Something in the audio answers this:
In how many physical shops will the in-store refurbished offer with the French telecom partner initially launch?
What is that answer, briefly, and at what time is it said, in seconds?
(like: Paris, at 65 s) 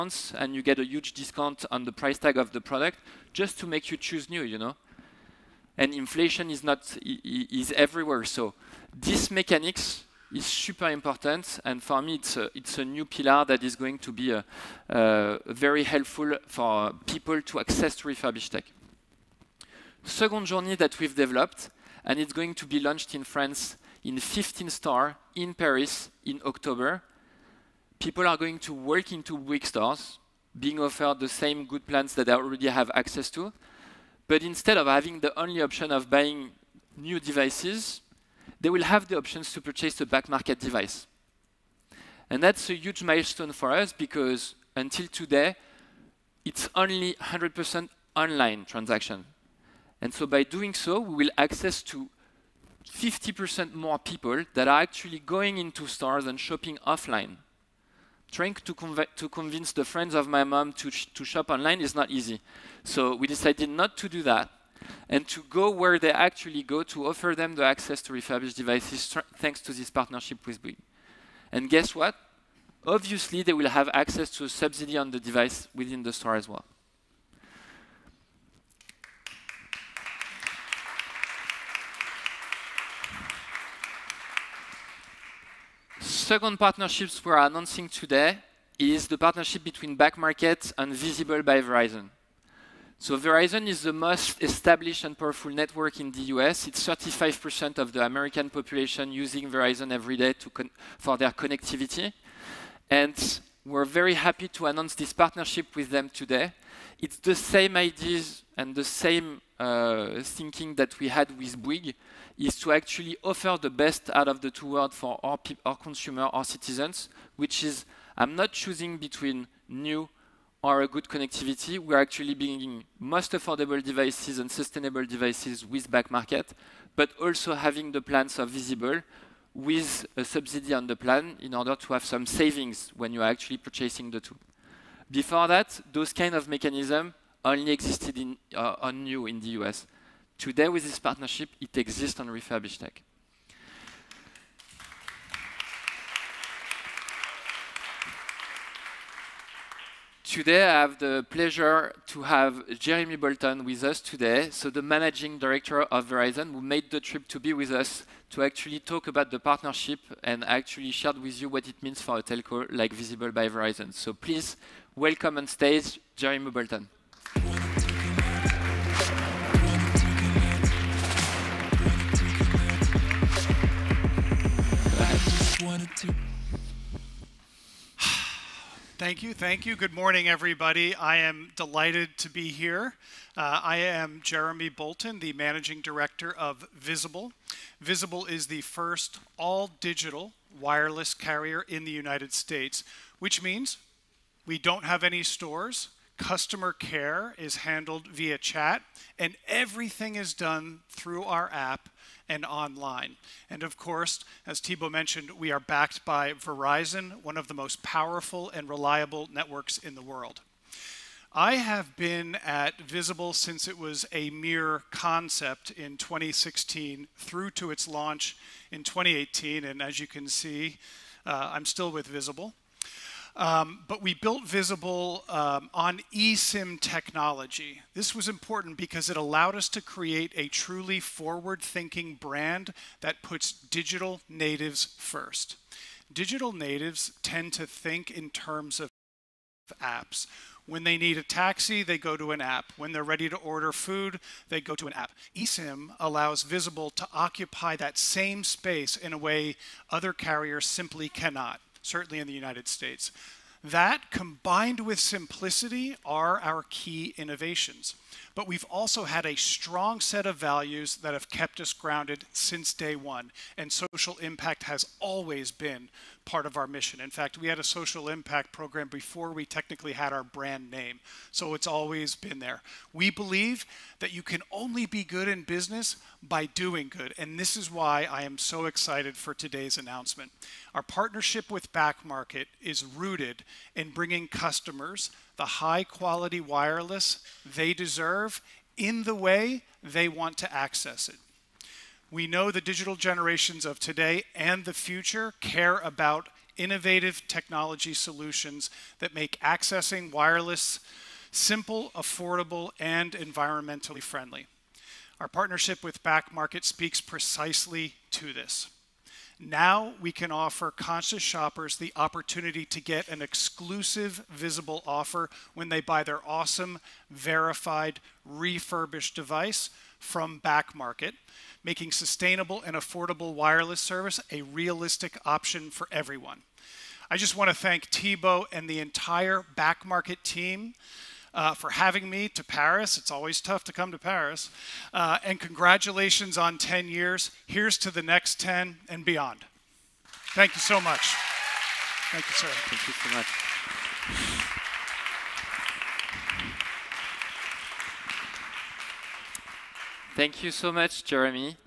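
15, at 24 s.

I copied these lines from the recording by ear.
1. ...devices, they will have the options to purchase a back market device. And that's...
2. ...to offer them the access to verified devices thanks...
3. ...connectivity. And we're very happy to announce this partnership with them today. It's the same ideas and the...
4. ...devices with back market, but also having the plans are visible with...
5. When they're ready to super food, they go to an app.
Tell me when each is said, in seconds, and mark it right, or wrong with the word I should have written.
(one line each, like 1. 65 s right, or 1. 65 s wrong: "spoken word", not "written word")
1. 37 s right
2. 66 s wrong: "refurbished", not "verified"
3. 101 s right
4. 125 s right
5. 242 s wrong: "order", not "super".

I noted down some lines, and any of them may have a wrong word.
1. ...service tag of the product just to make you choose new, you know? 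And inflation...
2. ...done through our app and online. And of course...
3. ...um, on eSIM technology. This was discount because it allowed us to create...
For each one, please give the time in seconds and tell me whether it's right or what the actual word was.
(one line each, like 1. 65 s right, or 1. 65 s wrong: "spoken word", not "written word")
1. 1 s wrong: "price", not "service"
2. 200 s right
3. 225 s wrong: "important", not "discount".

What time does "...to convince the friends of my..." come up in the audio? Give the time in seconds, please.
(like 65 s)
59 s.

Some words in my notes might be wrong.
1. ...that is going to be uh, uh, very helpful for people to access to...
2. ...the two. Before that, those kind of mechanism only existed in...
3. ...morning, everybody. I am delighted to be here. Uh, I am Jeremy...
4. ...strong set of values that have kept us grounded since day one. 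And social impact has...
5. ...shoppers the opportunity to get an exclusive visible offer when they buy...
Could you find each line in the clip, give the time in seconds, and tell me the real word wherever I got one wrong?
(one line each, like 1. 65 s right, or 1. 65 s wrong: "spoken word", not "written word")
1. 13 s right
2. 134 s right
3. 179 s right
4. 259 s right
5. 311 s right.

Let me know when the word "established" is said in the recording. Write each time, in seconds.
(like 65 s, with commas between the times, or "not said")
94 s.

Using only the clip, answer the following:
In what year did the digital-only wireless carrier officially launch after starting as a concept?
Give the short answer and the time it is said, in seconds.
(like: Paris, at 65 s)
2018, at 218 s.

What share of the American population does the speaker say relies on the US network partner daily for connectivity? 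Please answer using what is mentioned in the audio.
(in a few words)
35%.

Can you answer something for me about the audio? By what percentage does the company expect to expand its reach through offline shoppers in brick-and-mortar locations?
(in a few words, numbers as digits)
50%.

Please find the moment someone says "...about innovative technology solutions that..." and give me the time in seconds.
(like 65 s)
295 s.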